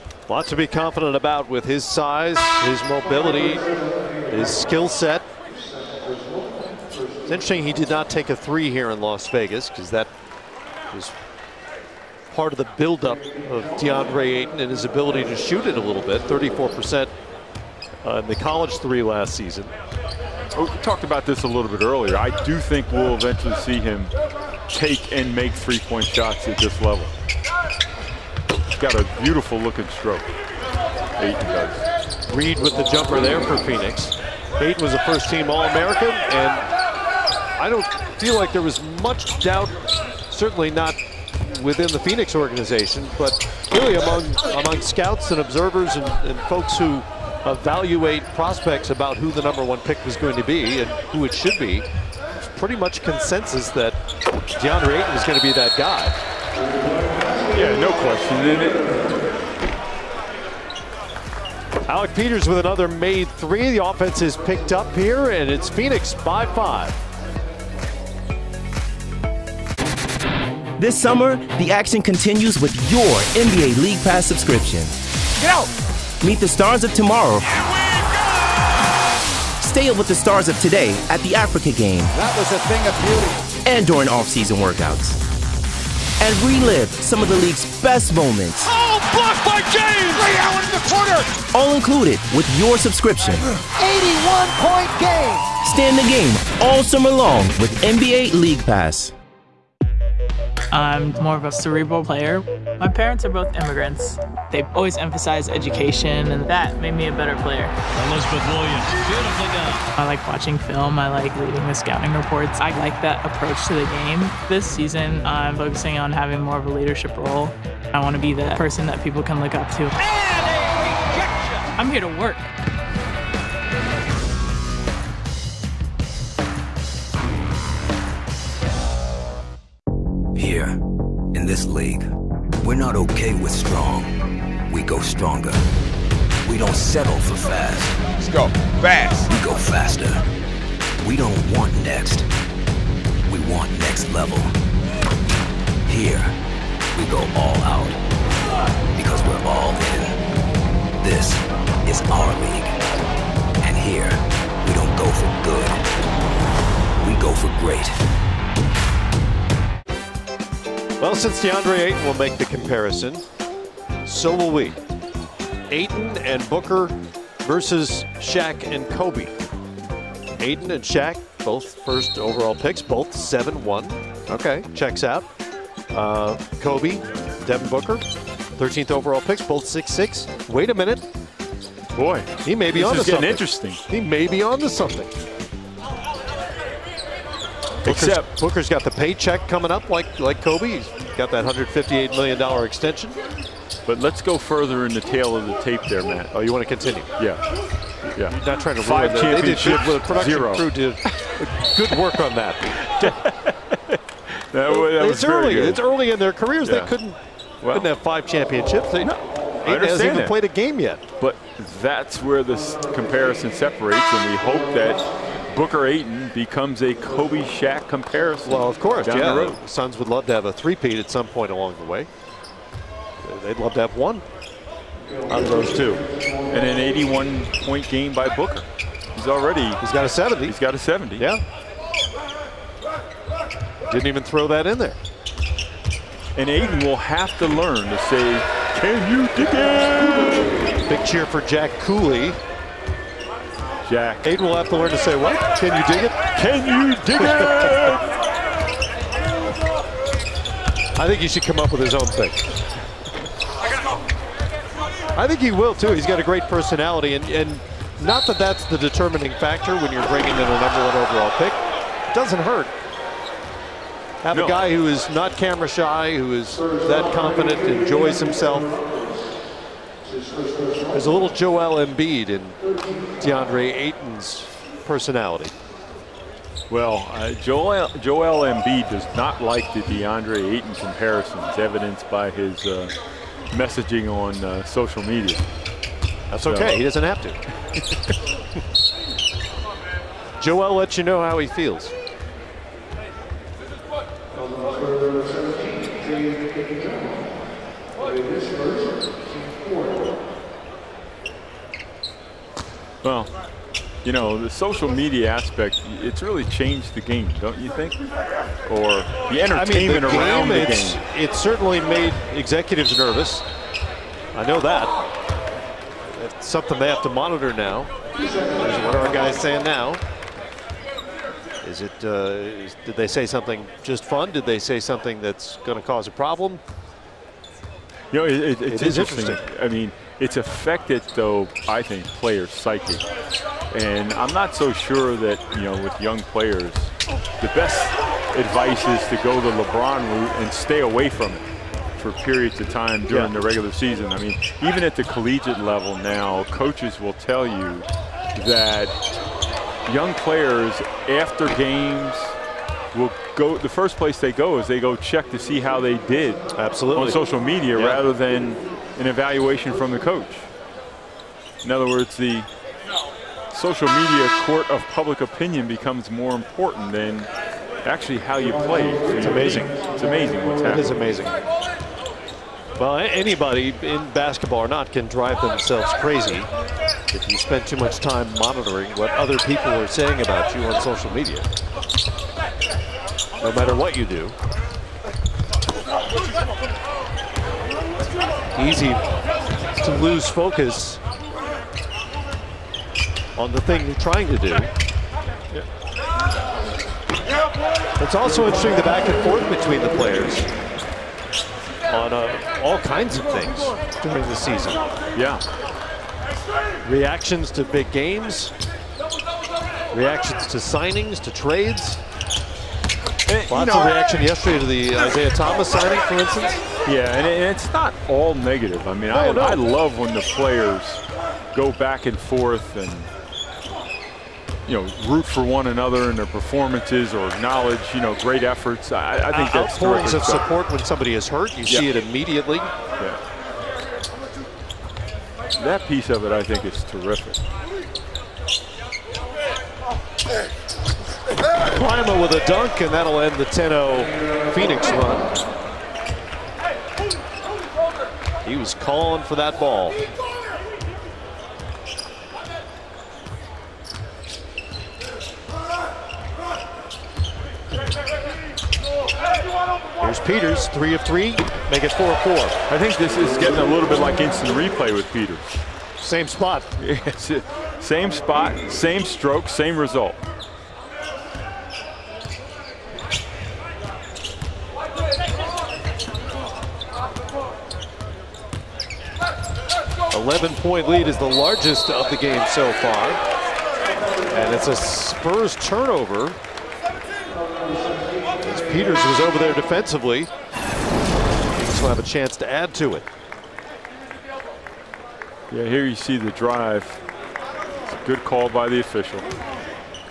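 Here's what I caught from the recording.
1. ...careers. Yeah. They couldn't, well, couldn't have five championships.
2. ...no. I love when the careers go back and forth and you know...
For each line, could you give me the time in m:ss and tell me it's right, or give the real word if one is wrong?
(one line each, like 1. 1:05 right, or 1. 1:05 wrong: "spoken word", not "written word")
1. 3:26 right
2. 6:59 wrong: "players", not "careers".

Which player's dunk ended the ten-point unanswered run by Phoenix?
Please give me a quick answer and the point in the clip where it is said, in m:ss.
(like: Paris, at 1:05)
Klima, at 7:21.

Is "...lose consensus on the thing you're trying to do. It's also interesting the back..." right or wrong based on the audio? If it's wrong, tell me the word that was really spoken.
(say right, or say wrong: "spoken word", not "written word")
wrong: "focus", not "consensus".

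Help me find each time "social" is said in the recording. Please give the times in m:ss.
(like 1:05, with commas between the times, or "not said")
4:44, 5:04, 5:57, 6:03, 6:20.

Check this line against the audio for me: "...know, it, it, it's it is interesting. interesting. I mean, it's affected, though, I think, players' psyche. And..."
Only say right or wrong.
right.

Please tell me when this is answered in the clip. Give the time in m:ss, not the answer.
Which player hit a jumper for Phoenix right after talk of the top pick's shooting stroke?
0:32.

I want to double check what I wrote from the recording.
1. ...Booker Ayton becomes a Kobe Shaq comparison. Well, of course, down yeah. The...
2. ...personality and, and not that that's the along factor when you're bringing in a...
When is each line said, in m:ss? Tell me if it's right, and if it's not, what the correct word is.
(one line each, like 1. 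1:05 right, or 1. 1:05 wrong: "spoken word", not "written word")
1. 3:35 right
2. 4:16 wrong: "determining", not "along".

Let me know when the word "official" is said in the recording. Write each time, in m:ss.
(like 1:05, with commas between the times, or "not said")
8:18.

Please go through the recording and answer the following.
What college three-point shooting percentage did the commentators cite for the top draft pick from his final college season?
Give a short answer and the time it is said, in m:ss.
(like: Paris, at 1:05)
34%, at 0:16.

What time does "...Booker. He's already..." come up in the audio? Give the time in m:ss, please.
3:48.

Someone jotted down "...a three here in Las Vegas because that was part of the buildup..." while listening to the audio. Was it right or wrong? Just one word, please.
right.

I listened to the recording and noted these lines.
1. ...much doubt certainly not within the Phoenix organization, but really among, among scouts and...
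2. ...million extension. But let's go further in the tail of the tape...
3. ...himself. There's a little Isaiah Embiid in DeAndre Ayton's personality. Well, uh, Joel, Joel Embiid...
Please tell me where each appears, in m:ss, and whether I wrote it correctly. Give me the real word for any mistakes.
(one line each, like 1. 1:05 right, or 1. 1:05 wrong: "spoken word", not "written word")
1. 0:39 right
2. 3:12 right
3. 4:28 wrong: "Joel", not "Isaiah".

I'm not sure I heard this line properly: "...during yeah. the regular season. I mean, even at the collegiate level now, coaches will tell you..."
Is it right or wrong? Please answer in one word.
right.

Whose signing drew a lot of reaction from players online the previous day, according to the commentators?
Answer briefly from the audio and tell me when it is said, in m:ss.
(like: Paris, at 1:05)
Isaiah Thomas, at 6:54.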